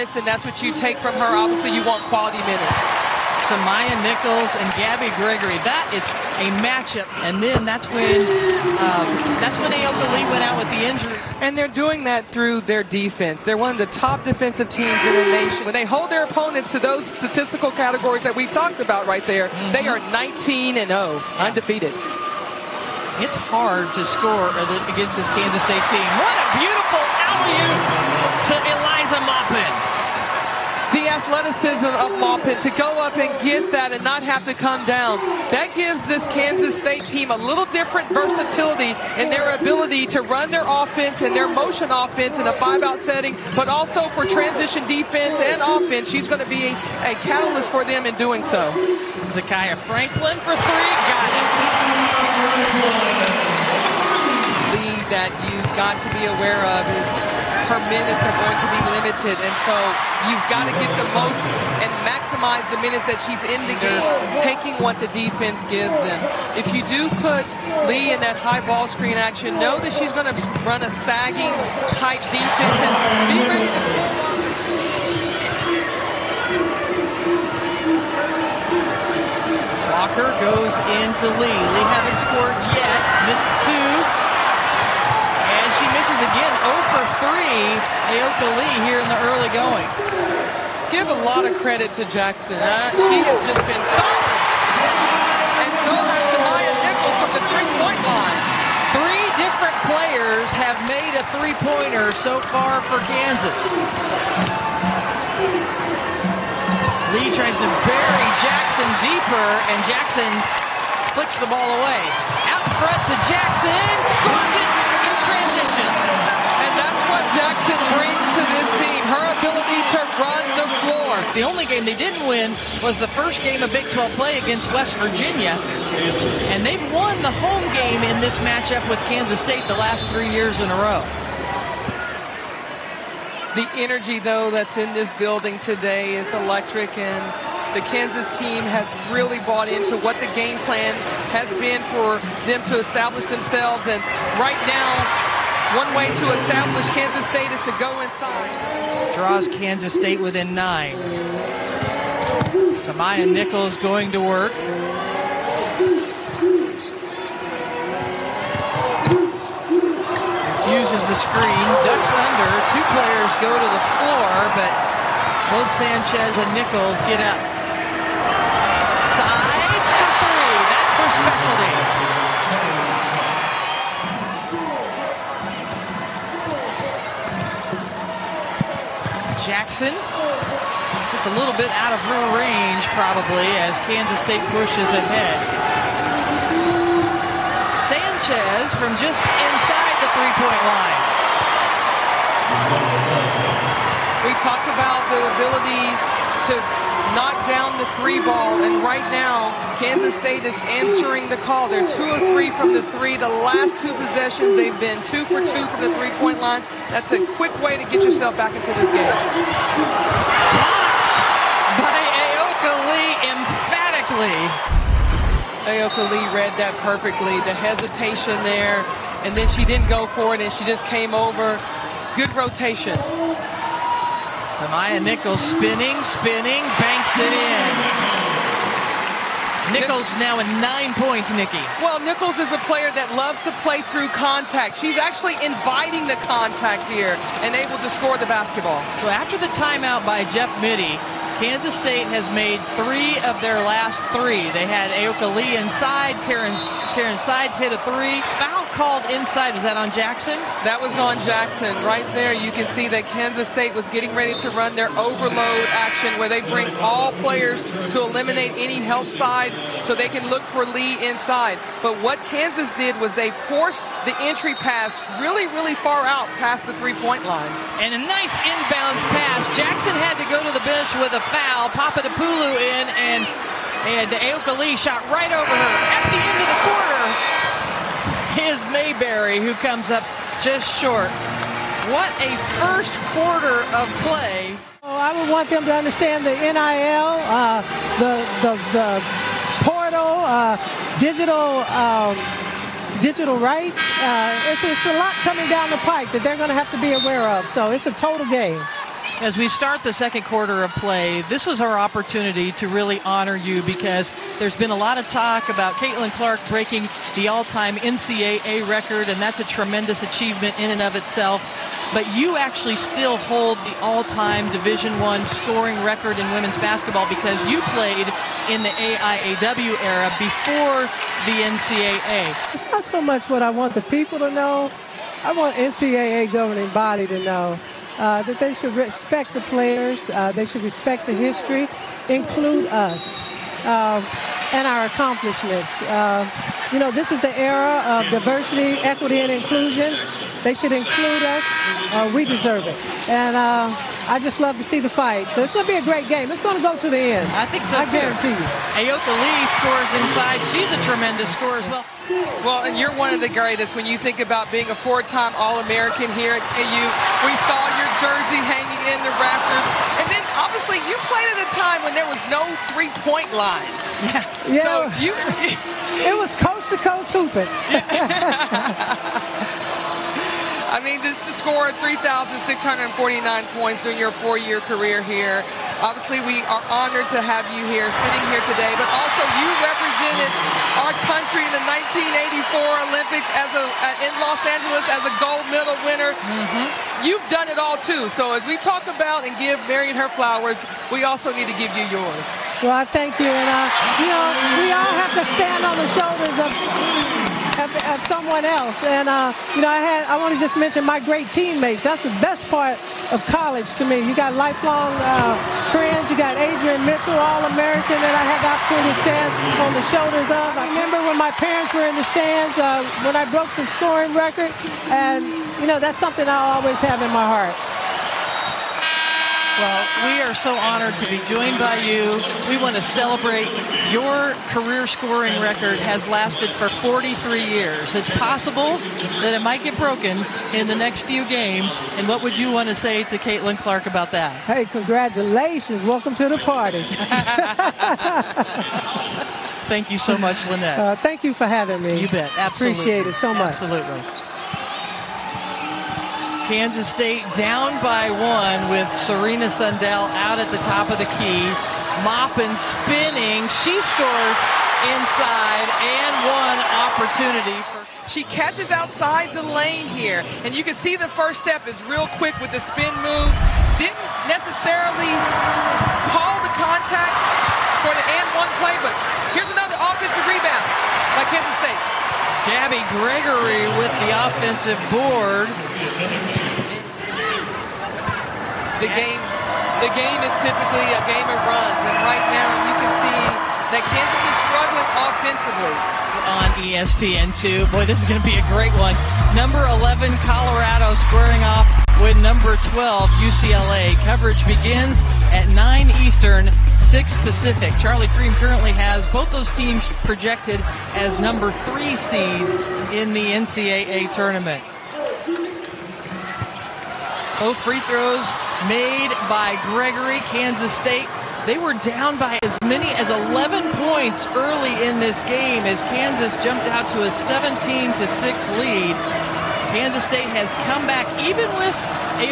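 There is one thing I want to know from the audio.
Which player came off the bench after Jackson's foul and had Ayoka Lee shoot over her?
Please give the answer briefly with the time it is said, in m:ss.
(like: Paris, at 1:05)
Papadopoulou, at 4:31.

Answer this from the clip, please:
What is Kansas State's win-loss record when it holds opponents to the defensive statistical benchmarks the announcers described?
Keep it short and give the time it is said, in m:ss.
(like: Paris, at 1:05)
19 and 0, at 0:20.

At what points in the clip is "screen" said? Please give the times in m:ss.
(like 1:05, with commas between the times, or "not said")
1:08, 2:41.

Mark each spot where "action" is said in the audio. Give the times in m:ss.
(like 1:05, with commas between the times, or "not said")
1:09, 4:15.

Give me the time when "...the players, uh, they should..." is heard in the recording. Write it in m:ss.
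5:29.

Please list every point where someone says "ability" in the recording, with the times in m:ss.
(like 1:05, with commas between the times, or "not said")
0:39, 3:15.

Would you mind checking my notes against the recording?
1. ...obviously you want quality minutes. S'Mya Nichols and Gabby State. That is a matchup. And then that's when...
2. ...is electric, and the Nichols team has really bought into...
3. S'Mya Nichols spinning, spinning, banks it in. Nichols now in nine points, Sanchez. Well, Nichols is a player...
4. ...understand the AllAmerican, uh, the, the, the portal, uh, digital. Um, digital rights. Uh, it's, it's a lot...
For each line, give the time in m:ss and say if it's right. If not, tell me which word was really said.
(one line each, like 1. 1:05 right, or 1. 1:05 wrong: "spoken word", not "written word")
1. 0:01 wrong: "Gregory", not "State"
2. 2:16 wrong: "Kansas", not "Nichols"
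3. 3:44 wrong: "Nikki", not "Sanchez"
4. 4:45 wrong: "NIL", not "AllAmerican".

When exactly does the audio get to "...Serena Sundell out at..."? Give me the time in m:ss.
7:28.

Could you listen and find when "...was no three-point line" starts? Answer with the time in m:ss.
6:02.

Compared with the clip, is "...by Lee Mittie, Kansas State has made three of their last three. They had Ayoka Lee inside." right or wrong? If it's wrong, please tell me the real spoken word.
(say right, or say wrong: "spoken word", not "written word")
wrong: "Jeff", not "Lee".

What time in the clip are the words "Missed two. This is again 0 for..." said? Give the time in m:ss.
1:23.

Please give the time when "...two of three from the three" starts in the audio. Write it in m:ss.
3:21.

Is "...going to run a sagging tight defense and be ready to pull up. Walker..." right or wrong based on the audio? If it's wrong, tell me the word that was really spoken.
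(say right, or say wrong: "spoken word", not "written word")
right.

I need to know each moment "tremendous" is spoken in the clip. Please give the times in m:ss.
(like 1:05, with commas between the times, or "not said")
5:09, 5:50.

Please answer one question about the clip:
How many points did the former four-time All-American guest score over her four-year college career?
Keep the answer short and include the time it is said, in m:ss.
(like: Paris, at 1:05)
3,649, at 6:11.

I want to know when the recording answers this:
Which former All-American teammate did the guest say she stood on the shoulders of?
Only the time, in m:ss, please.
6:46.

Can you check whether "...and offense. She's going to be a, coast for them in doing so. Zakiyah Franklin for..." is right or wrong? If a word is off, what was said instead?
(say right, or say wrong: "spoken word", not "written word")
wrong: "catalyst", not "coast".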